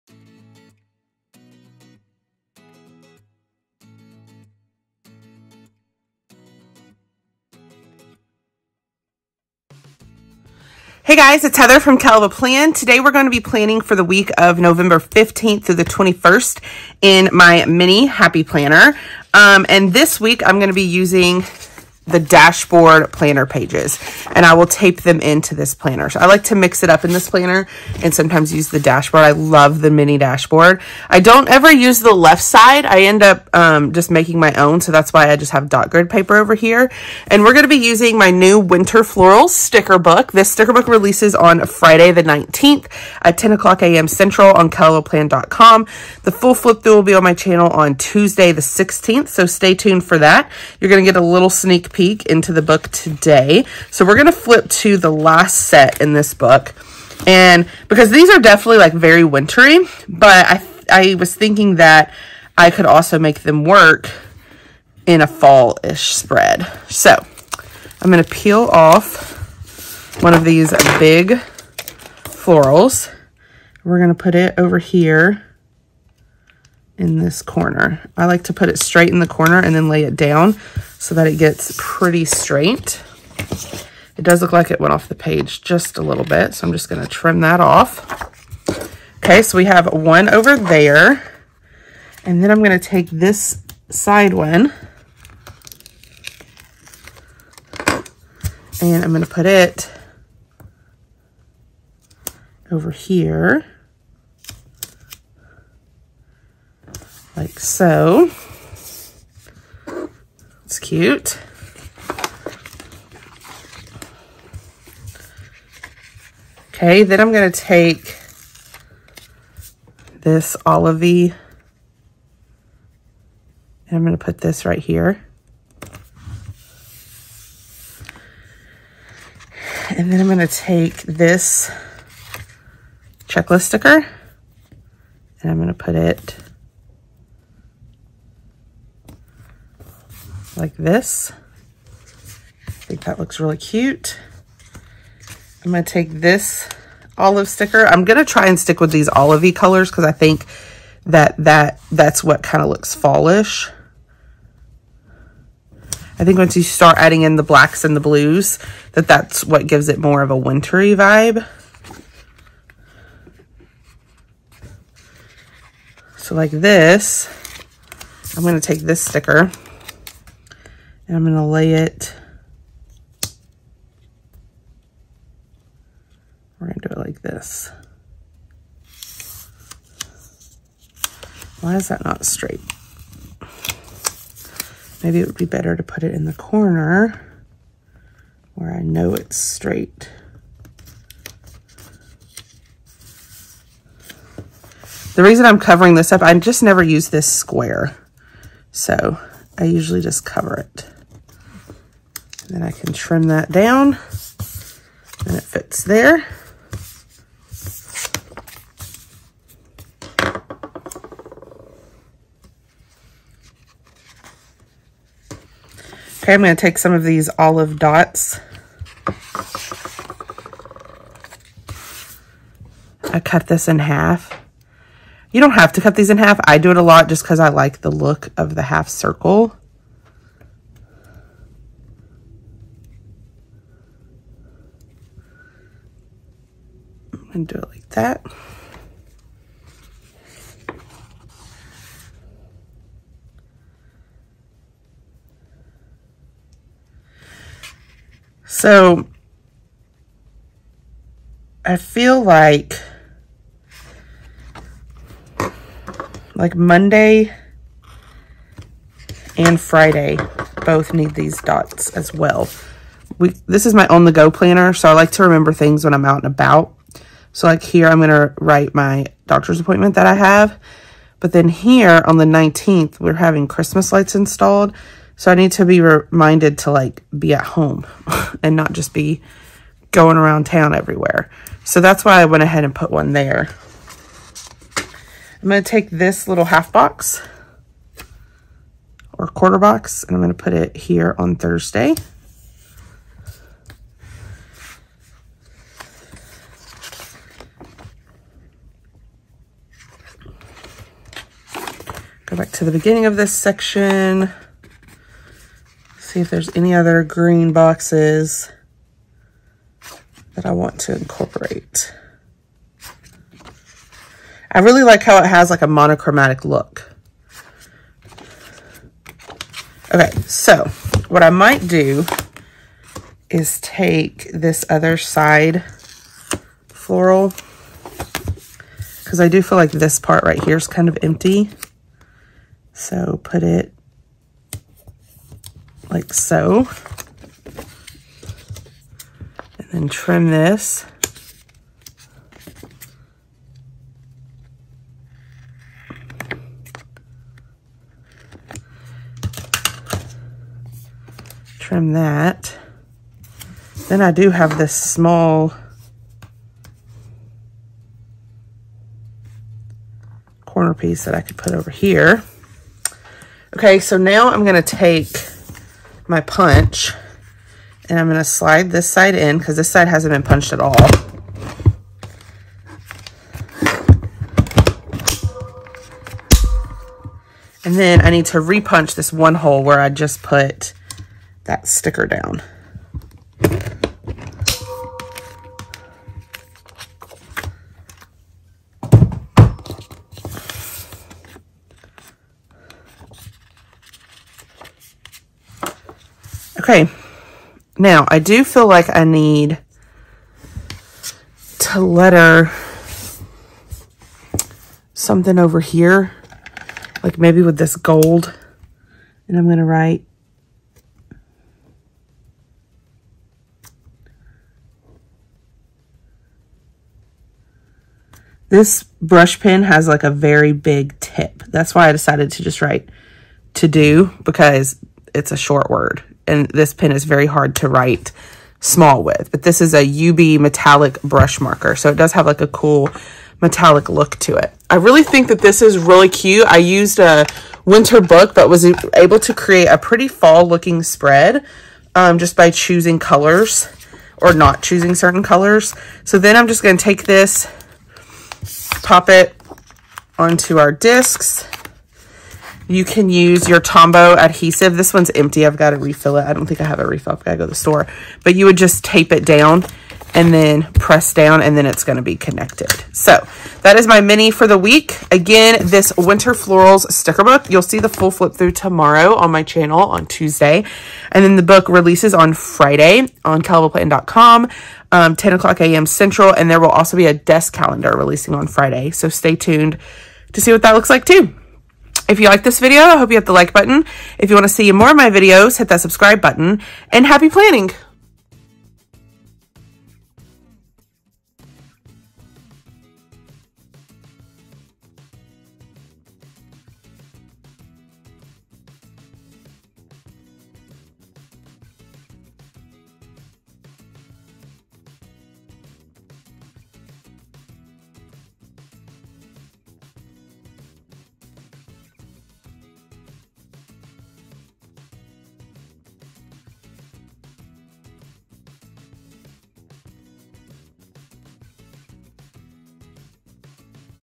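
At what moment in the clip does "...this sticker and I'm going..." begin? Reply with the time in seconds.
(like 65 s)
168 s.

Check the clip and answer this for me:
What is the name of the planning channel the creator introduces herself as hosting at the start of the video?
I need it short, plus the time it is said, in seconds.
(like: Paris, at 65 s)
Kell of a Plan, at 11 s.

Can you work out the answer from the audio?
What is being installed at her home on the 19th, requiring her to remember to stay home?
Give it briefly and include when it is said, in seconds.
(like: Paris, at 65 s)
Christmas lights, at 273 s.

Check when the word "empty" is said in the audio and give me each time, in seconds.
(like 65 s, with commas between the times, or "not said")
331 s, 455 s.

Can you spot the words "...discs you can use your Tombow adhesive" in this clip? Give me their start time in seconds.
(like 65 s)
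450 s.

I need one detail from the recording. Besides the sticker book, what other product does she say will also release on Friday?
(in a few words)
desk calendar.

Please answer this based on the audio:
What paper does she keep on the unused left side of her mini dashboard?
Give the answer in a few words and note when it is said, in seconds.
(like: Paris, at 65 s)
dot grid paper, at 35 s.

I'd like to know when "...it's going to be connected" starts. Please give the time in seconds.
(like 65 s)
461 s.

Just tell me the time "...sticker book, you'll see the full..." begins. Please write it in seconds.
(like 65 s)
466 s.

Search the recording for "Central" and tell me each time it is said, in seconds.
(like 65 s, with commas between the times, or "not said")
44 s, 475 s.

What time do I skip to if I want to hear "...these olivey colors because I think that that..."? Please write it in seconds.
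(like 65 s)
148 s.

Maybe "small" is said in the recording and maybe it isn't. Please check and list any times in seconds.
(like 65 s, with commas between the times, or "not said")
354 s, 428 s.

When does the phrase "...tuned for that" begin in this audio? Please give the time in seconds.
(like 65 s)
49 s.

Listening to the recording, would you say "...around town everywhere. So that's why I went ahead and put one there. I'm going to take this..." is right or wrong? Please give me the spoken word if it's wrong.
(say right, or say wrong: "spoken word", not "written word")
right.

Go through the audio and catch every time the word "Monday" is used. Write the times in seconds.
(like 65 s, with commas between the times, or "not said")
256 s.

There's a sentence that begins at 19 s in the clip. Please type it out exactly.
Um, and this week I'm going to be using the dashboard planner pages and I will tape them into this planner.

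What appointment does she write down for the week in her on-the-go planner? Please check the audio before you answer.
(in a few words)
doctor's appointment.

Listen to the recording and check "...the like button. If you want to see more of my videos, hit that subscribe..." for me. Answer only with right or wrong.
right.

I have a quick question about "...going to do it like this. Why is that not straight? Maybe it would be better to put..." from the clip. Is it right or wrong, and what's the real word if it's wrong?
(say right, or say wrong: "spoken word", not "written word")
right.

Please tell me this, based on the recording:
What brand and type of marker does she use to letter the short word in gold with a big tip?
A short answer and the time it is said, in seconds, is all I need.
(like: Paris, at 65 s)
UB metallic brush marker, at 430 s.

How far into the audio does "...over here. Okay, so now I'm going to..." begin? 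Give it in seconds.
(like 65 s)
361 s.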